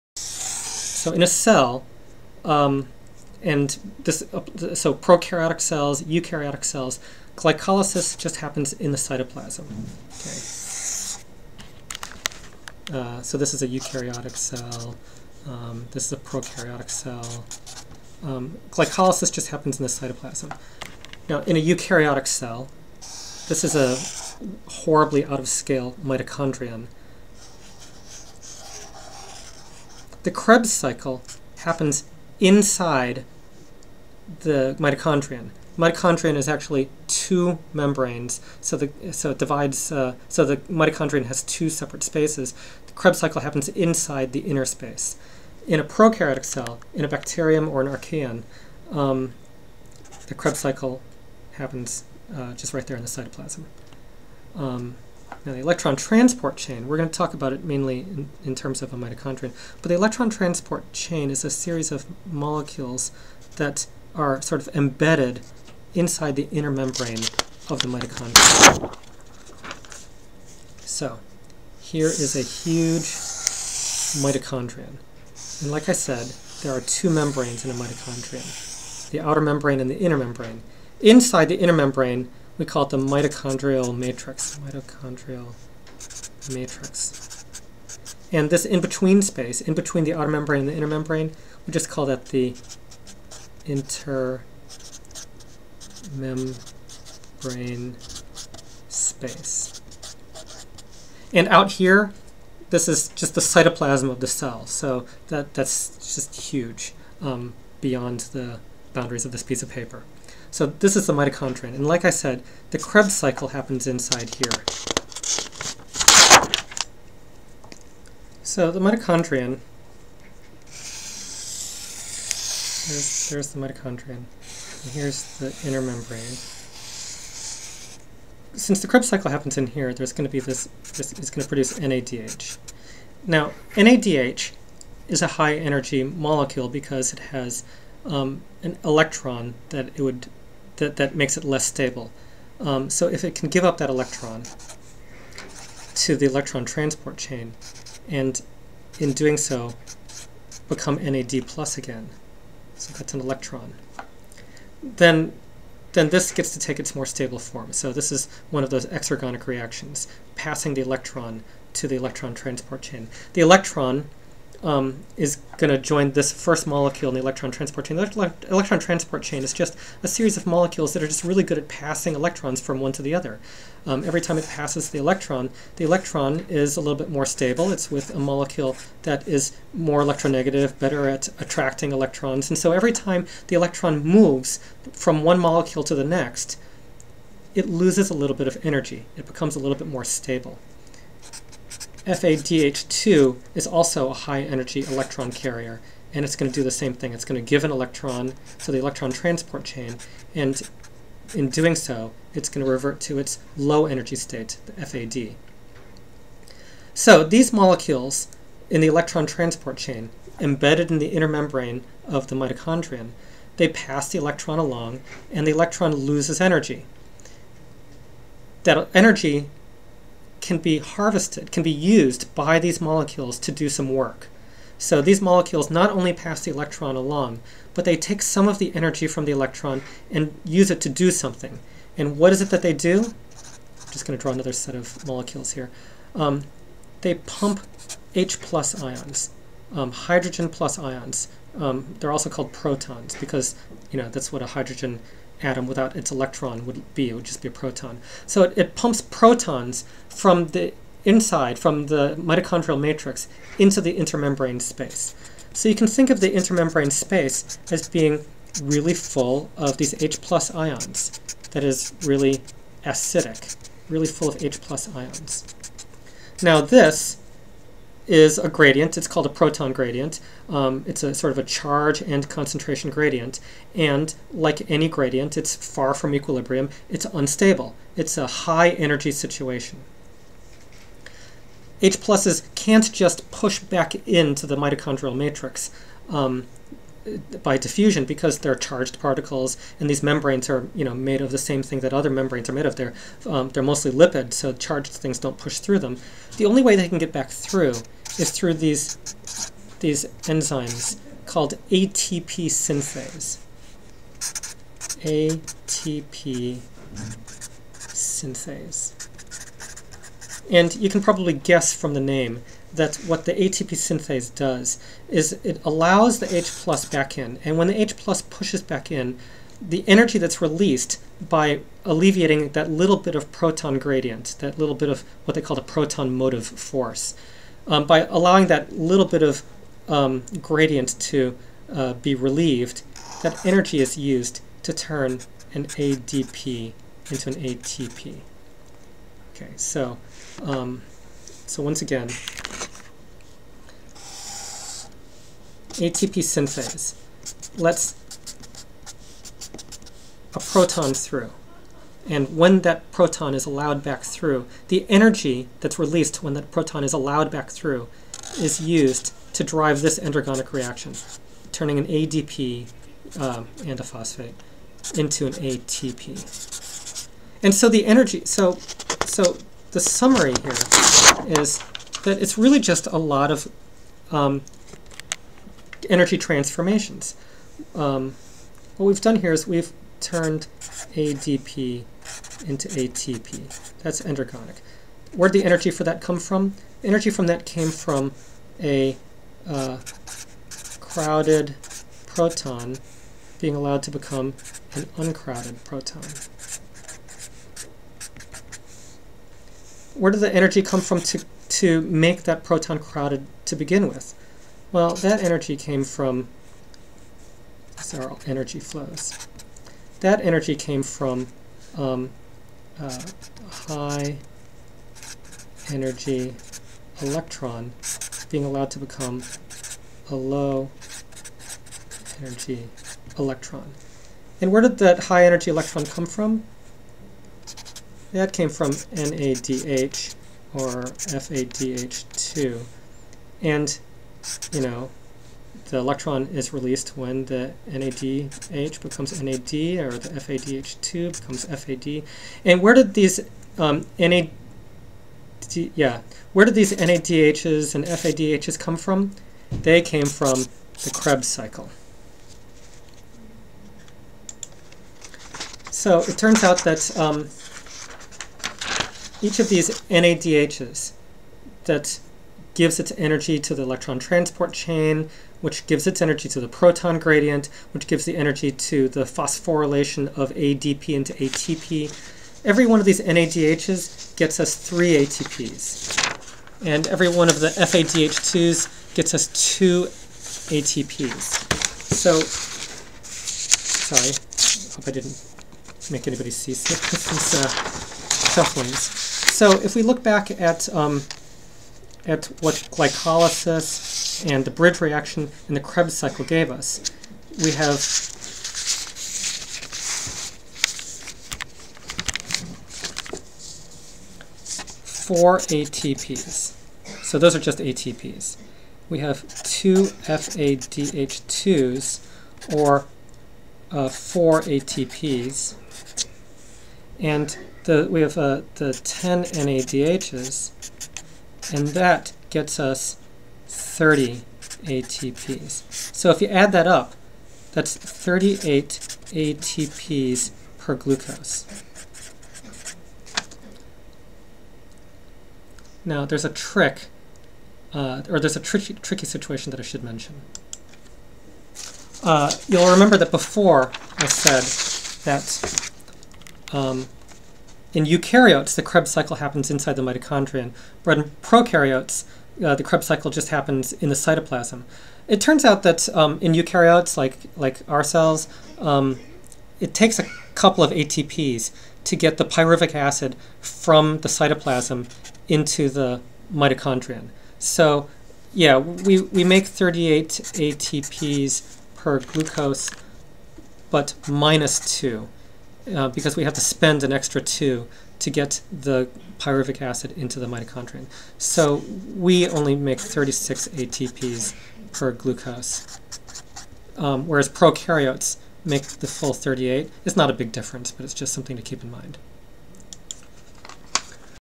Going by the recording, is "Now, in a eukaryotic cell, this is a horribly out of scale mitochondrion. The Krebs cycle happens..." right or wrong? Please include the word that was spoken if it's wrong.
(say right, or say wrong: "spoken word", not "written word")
right.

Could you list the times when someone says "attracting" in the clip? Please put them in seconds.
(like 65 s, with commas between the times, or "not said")
181 s.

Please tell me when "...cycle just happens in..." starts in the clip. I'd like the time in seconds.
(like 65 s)
552 s.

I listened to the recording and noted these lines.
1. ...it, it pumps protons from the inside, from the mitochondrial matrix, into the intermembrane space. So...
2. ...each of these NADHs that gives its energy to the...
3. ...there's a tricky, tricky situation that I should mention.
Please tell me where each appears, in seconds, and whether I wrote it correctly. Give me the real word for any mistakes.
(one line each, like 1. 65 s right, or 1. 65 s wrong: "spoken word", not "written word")
1. 248 s right
2. 459 s right
3. 538 s right.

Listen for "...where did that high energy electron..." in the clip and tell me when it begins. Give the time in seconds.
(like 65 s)
424 s.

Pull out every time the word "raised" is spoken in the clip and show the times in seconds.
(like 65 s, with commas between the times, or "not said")
not said.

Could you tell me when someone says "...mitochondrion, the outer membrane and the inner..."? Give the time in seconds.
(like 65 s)
77 s.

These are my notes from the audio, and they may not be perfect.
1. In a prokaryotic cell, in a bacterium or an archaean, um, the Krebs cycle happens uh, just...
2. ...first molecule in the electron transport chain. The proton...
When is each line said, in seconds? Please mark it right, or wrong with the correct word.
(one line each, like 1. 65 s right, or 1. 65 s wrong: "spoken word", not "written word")
1. 45 s right
2. 166 s wrong: "electron", not "proton".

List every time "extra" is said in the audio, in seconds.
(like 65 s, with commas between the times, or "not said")
576 s.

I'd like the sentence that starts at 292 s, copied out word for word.
They're um, they're mostly lipid, so charged things don't push through them.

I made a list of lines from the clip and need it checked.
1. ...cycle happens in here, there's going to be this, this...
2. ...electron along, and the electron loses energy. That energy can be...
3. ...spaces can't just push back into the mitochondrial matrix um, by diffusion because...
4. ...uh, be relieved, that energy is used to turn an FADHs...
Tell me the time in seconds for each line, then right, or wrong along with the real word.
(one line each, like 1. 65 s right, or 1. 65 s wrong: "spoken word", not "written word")
1. 129 s right
2. 214 s right
3. 281 s wrong: "pluses", not "spaces"
4. 331 s wrong: "ADP", not "FADHs".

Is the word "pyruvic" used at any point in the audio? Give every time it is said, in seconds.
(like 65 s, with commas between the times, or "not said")
562 s, 579 s.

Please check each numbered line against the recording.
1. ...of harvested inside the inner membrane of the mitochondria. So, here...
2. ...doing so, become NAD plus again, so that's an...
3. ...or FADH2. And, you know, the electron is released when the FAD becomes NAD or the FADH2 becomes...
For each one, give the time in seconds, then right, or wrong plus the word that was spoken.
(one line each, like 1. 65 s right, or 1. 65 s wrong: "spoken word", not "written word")
1. 64 s wrong: "embedded", not "harvested"
2. 149 s right
3. 430 s wrong: "NADH", not "FAD".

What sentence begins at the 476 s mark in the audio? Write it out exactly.
And every one of the FADH2s gets us two ATPs.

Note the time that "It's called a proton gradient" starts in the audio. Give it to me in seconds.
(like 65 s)
268 s.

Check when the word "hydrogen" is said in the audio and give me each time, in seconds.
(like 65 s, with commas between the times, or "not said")
239 s, 244 s.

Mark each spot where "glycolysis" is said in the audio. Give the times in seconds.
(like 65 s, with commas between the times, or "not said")
7 s, 18 s, 492 s.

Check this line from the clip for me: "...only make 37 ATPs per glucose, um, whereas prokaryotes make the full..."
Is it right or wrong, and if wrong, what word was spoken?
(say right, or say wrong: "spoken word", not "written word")
wrong: "36", not "37".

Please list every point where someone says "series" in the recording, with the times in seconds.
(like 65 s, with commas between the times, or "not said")
61 s, 170 s.